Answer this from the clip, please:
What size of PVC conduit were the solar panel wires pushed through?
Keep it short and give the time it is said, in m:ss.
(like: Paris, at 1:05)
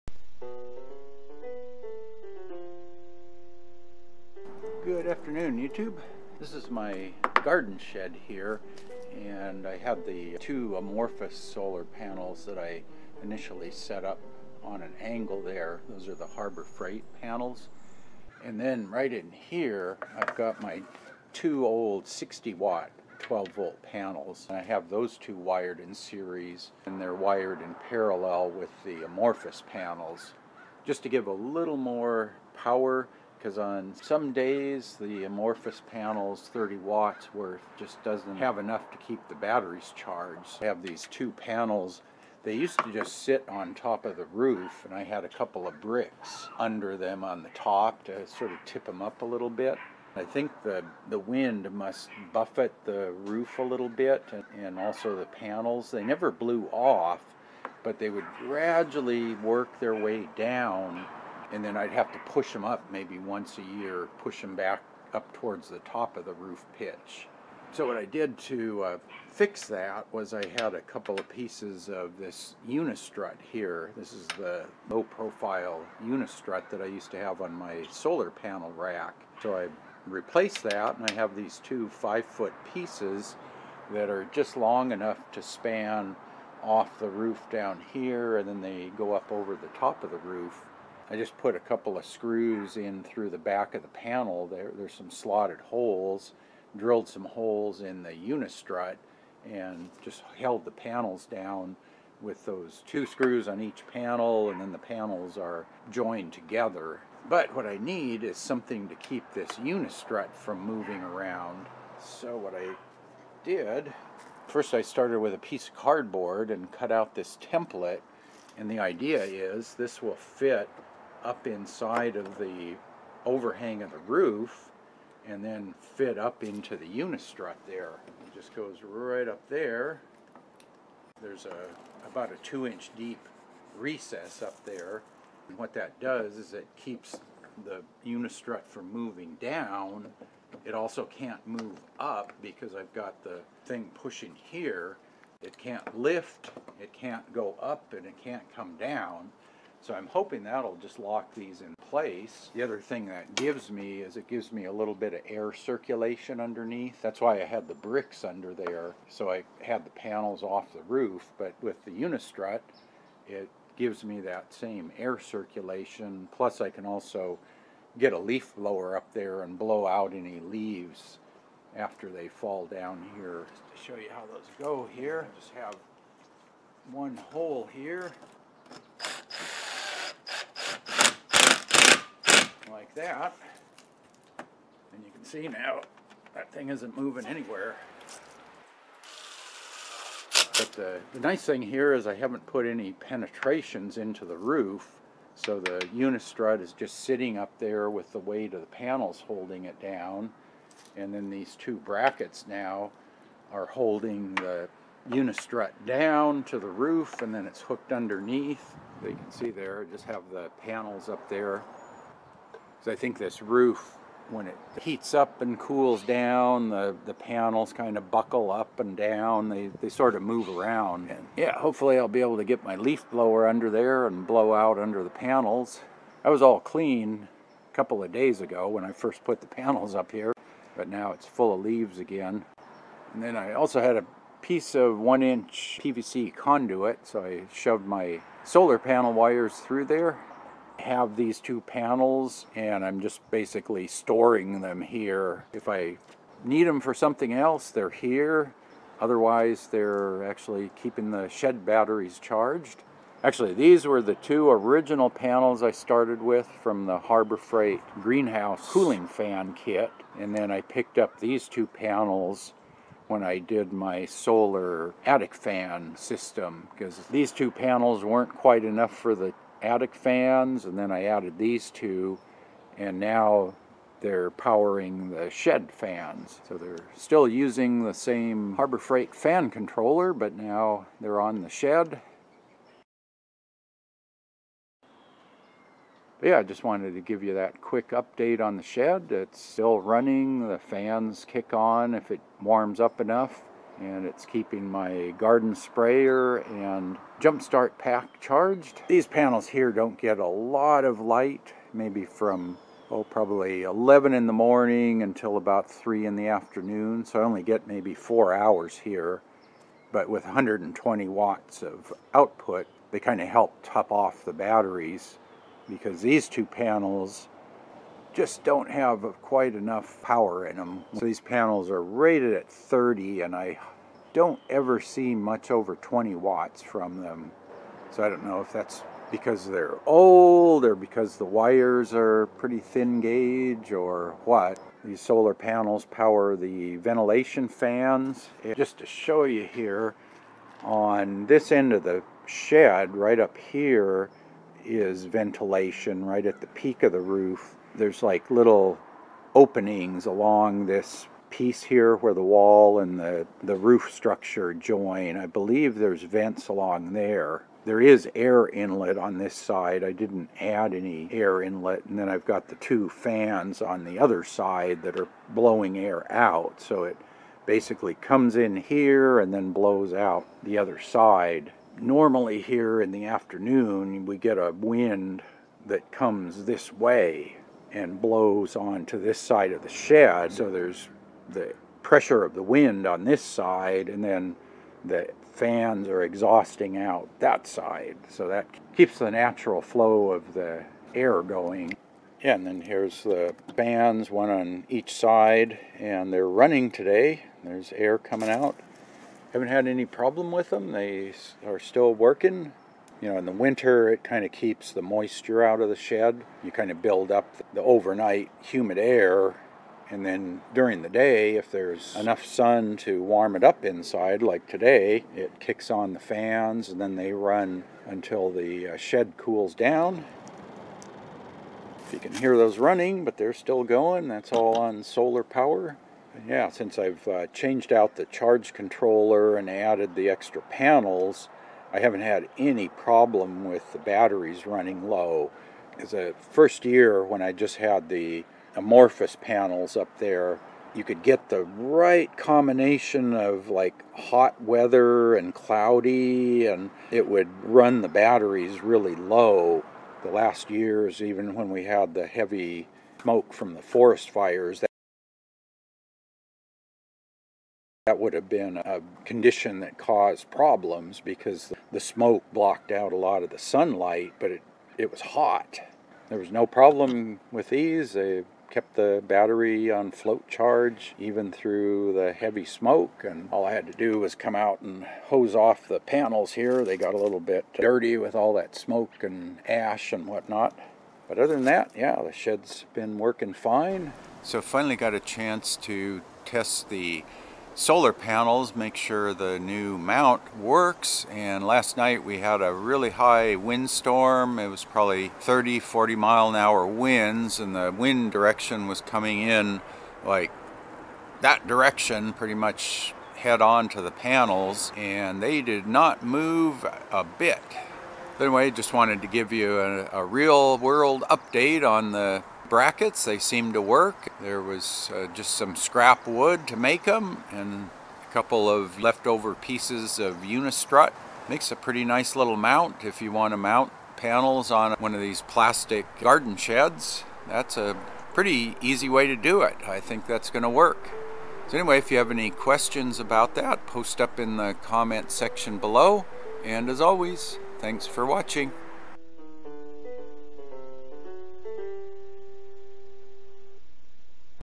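1 inch, at 3:54.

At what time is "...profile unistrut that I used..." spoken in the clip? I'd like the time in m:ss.
1:15.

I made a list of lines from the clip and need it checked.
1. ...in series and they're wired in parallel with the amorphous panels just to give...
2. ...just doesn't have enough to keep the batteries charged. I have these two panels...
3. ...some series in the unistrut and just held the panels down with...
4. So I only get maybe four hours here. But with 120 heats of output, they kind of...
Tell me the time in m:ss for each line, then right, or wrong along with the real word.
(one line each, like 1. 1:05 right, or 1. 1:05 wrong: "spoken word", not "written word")
1. 0:25 right
2. 0:37 right
3. 1:37 wrong: "holes", not "series"
4. 5:07 wrong: "watts", not "heats".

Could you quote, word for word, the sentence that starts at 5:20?
So these panels are rated at 30 and I don't ever see much over 20 watts from them.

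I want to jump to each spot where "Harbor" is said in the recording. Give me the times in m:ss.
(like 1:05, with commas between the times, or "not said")
0:16, 4:16, 4:38.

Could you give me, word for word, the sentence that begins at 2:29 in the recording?
So I'm hoping that'll just lock these in place.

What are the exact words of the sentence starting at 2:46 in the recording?
Plus I can also get a leaf blower up there and blow out any leaves after they fall down here.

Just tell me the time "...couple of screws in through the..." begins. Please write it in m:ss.
1:31.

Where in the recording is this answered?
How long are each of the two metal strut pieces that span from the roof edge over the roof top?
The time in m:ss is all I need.
1:21.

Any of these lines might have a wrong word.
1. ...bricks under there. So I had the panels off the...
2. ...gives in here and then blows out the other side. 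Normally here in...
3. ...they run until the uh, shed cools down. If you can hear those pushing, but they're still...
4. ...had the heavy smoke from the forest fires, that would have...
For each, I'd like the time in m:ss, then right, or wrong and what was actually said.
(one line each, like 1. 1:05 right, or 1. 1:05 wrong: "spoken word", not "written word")
1. 2:37 right
2. 6:07 wrong: "comes", not "gives"
3. 6:56 wrong: "running", not "pushing"
4. 7:31 right.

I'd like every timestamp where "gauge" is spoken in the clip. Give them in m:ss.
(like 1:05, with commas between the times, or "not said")
5:33.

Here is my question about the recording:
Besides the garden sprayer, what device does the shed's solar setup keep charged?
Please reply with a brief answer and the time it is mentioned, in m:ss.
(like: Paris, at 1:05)
jumpstart pack, at 4:57.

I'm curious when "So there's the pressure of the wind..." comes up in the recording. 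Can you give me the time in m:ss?
6:20.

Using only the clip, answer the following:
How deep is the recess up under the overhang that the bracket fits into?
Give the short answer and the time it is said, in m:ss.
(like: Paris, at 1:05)
2 inches, at 2:12.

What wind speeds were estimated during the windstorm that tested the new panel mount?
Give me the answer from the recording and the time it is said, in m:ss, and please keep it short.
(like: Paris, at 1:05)
30 to 40 mph, at 8:15.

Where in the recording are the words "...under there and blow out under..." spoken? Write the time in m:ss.
3:43.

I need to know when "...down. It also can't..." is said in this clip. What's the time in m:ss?
2:19.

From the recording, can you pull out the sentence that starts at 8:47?
That's a pretty easy way to do it.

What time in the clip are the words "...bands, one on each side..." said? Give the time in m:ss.
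6:33.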